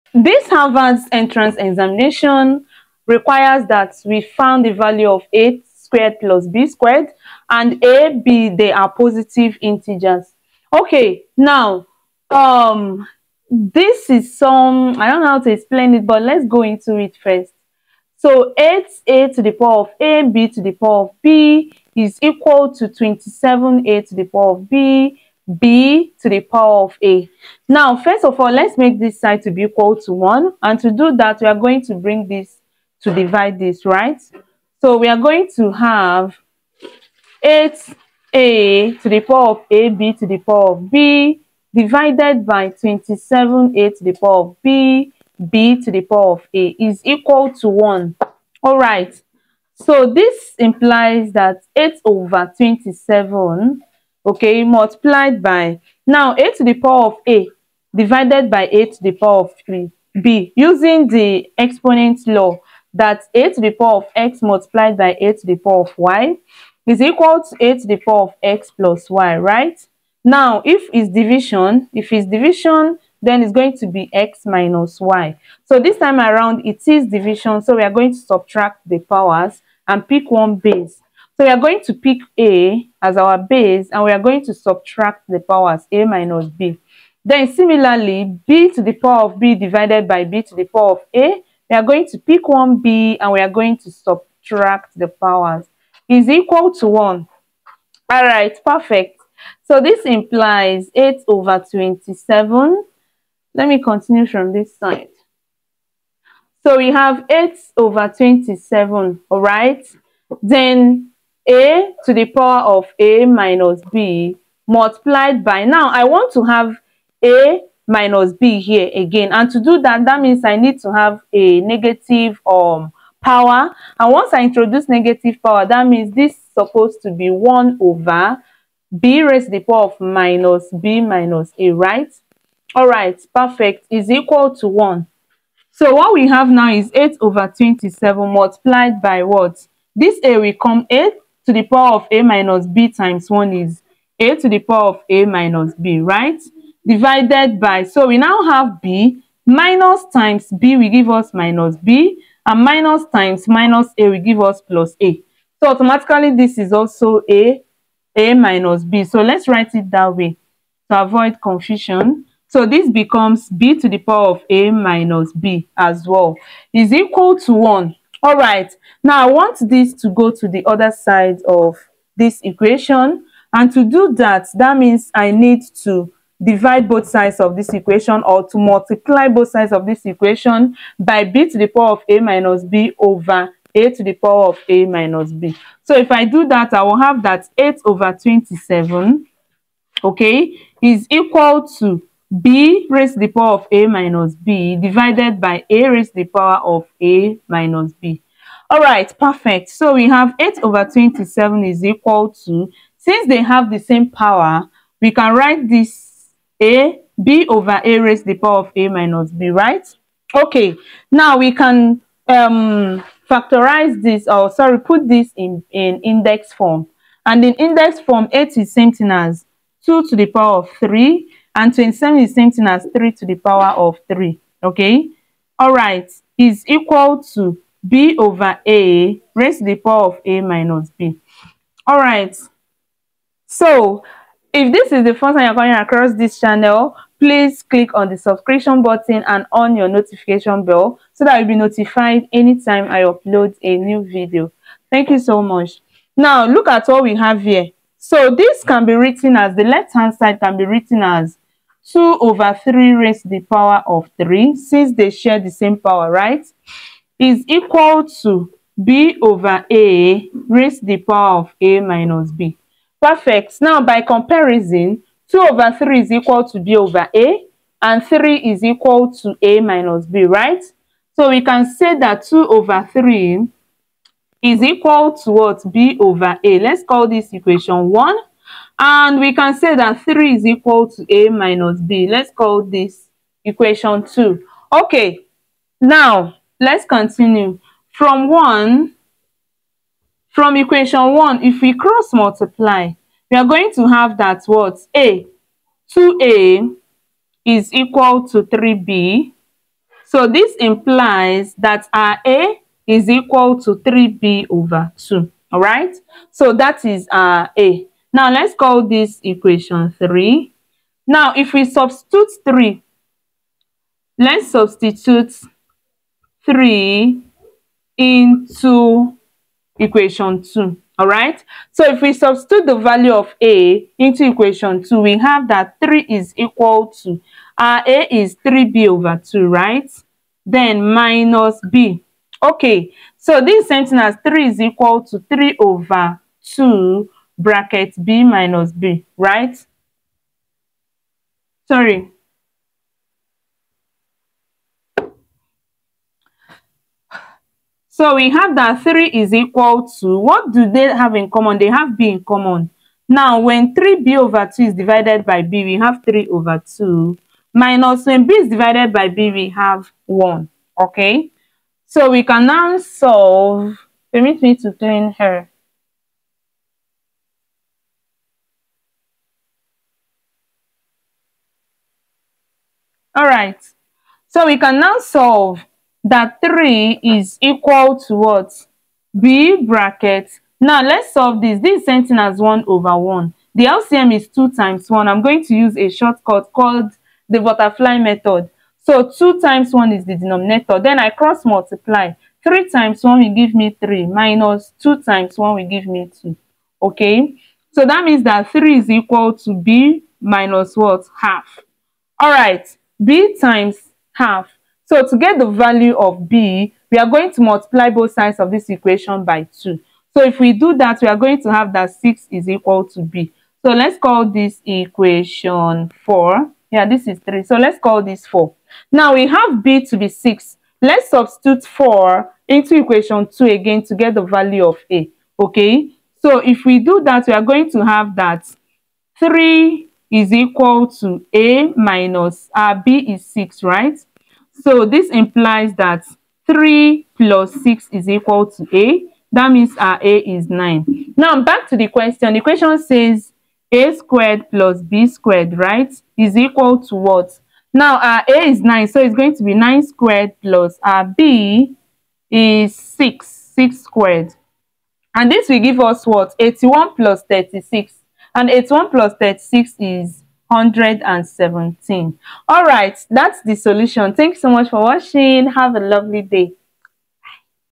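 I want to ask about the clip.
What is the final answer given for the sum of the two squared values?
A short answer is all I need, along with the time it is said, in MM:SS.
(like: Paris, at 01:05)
117, at 07:40.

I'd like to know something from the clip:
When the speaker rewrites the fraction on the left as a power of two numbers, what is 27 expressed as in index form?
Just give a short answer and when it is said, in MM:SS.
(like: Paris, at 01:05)
3 to the power of 3, at 03:42.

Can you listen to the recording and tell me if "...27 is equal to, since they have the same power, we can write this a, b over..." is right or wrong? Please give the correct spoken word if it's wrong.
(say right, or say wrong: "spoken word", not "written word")
right.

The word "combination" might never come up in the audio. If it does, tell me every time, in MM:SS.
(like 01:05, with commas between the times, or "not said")
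not said.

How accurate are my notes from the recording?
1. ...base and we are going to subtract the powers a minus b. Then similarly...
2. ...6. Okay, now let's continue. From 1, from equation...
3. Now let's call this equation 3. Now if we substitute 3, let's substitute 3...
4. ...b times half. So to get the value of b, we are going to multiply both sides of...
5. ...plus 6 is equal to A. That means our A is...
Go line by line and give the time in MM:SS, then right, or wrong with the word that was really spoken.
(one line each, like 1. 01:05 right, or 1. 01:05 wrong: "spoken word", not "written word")
1. 01:23 right
2. 04:44 wrong: "2", not "6"
3. 05:08 right
4. 06:43 right
5. 07:17 right.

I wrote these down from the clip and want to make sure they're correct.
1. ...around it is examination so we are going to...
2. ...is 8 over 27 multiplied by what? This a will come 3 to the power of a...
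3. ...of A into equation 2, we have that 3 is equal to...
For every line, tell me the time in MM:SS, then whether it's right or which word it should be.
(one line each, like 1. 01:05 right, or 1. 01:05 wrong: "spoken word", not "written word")
1. 01:16 wrong: "division", not "examination"
2. 02:16 wrong: "8", not "3"
3. 05:23 right.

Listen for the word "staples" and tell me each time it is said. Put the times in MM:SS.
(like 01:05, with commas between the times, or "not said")
not said.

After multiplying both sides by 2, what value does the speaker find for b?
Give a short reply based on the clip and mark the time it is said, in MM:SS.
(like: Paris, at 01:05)
6, at 06:51.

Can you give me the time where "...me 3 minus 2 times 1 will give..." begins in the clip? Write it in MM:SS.
06:33.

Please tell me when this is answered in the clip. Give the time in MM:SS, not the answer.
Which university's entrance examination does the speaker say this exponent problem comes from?
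00:00.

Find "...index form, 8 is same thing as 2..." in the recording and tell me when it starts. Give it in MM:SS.
03:37.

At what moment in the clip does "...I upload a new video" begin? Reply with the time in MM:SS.
04:02.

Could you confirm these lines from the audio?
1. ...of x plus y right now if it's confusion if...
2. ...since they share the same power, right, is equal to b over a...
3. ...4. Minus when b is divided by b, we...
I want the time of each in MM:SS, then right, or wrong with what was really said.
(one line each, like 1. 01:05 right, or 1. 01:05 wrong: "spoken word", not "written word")
1. 01:08 wrong: "division", not "confusion"
2. 04:14 right
3. 05:56 wrong: "2", not "4".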